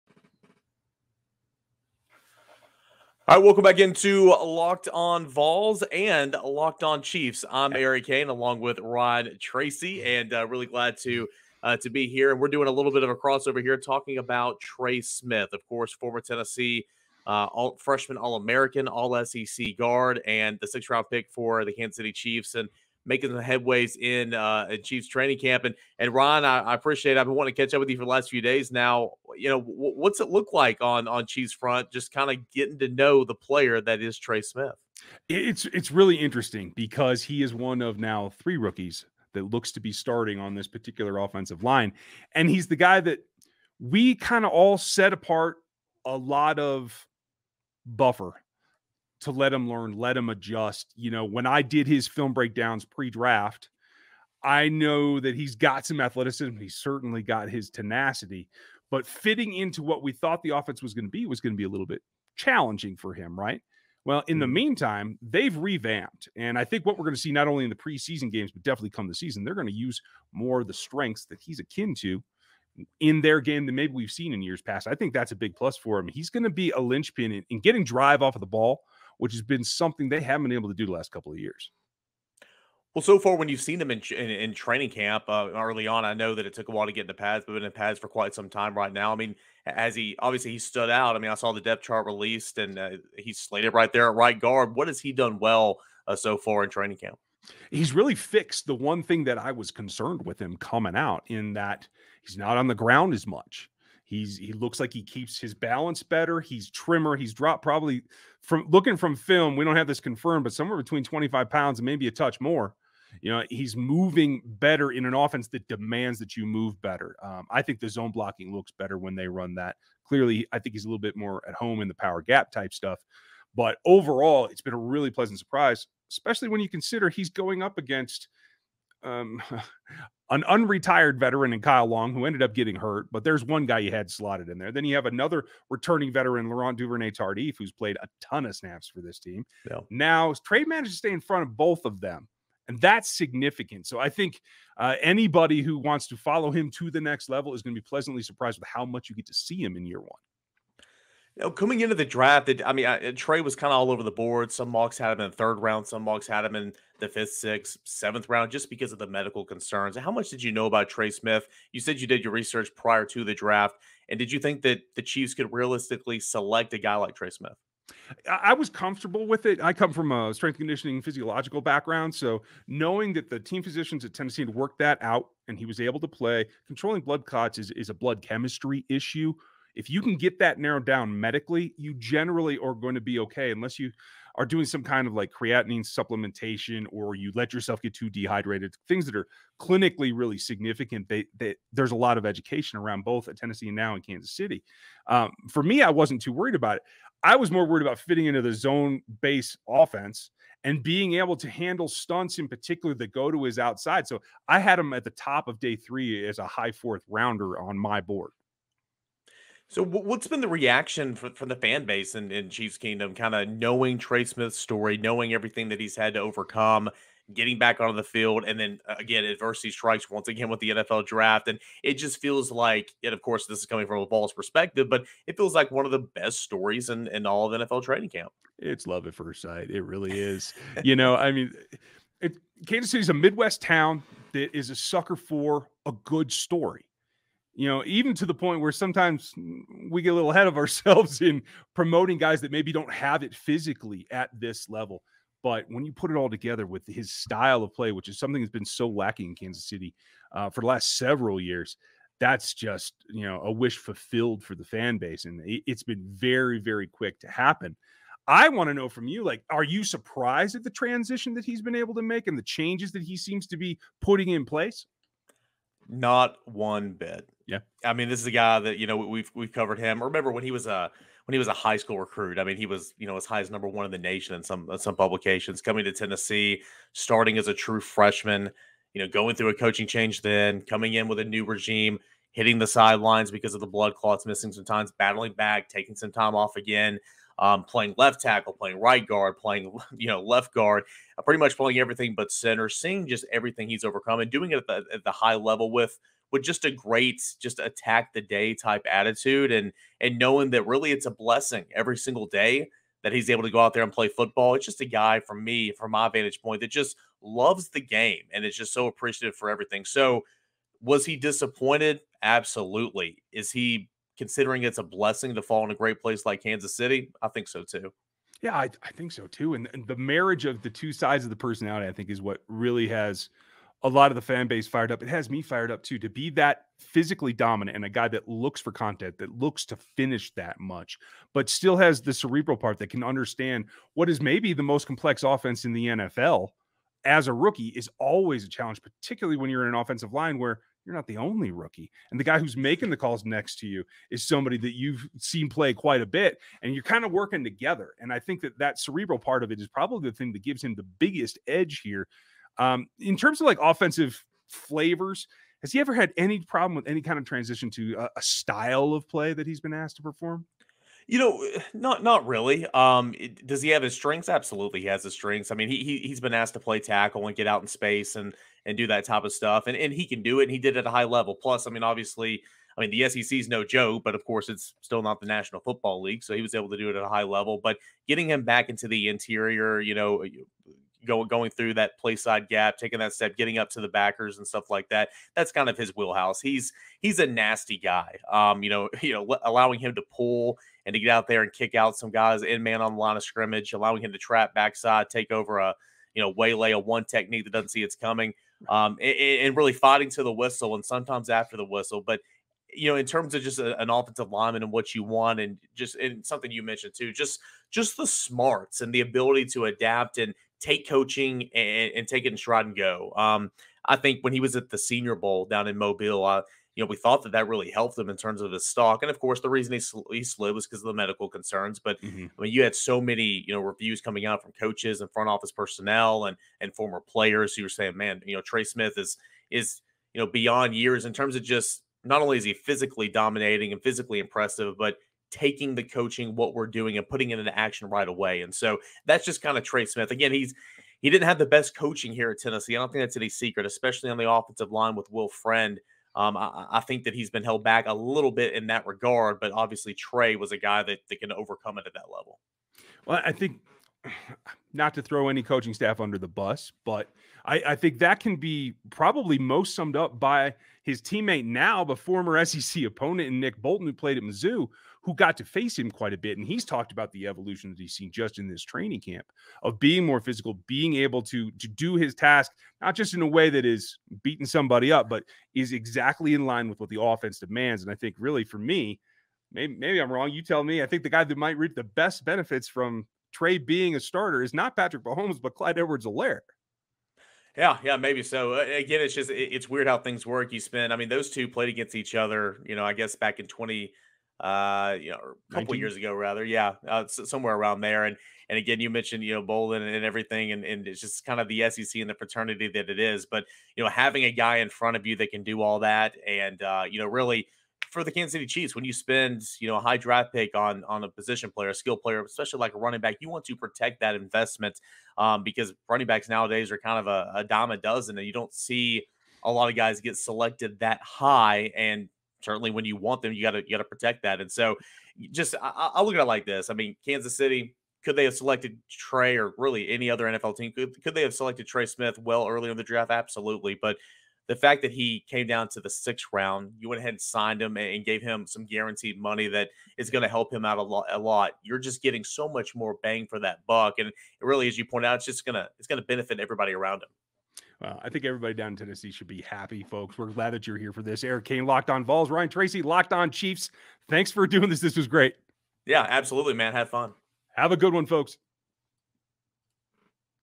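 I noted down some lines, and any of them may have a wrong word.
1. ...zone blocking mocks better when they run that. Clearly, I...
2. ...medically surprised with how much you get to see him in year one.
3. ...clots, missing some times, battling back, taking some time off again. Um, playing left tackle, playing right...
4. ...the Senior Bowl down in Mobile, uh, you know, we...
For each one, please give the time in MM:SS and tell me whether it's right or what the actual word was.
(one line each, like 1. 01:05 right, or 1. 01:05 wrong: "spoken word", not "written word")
1. 01:57 wrong: "looks", not "mocks"
2. 02:27 wrong: "pleasantly", not "medically"
3. 04:43 right
4. 06:54 right.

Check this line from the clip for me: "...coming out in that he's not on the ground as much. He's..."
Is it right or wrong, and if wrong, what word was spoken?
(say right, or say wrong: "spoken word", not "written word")
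right.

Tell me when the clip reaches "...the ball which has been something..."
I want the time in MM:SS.
01:18.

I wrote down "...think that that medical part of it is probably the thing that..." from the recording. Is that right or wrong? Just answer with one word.
wrong.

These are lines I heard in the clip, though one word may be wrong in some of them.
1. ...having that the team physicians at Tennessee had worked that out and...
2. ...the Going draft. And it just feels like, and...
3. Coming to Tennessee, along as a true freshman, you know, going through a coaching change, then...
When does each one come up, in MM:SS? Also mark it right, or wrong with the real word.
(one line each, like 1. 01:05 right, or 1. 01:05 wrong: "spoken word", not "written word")
1. 02:52 wrong: "knowing", not "having"
2. 03:40 wrong: "NFL", not "Going"
3. 04:35 wrong: "starting", not "along".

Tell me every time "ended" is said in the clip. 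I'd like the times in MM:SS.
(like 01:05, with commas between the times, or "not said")
02:12.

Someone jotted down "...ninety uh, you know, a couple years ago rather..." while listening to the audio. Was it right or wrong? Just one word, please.
wrong.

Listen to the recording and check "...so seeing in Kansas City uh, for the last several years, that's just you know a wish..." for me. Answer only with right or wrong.
wrong.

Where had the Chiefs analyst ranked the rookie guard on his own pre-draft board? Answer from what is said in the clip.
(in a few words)
High fourth rounder.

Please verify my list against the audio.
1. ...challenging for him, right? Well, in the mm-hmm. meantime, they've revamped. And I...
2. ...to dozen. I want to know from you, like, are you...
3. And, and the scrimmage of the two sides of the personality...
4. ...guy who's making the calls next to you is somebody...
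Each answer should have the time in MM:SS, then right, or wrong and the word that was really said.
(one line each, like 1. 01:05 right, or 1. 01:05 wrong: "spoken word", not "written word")
1. 01:02 right
2. 04:17 wrong: "happen", not "dozen"
3. 05:19 wrong: "marriage", not "scrimmage"
4. 05:42 right.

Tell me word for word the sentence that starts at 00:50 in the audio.
You know, when I did his film breakdowns pre-draft, I know that he's got some athleticism.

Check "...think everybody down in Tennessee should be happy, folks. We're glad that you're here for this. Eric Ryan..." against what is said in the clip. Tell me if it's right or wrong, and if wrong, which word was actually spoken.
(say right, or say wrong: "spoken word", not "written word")
wrong: "Cain", not "Ryan".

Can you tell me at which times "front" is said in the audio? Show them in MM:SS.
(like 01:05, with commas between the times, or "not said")
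00:31, 02:21, 07:05, 08:24.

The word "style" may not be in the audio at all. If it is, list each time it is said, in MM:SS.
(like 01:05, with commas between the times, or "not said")
04:07, 05:58.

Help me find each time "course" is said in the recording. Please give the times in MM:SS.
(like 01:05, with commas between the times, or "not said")
00:15, 03:43, 06:14, 06:59.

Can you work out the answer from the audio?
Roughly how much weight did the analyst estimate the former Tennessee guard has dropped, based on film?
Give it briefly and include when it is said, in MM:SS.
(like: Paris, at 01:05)
25 pounds, at 01:51.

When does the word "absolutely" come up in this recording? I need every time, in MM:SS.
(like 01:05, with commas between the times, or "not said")
05:12, 06:04, 08:53, 09:16.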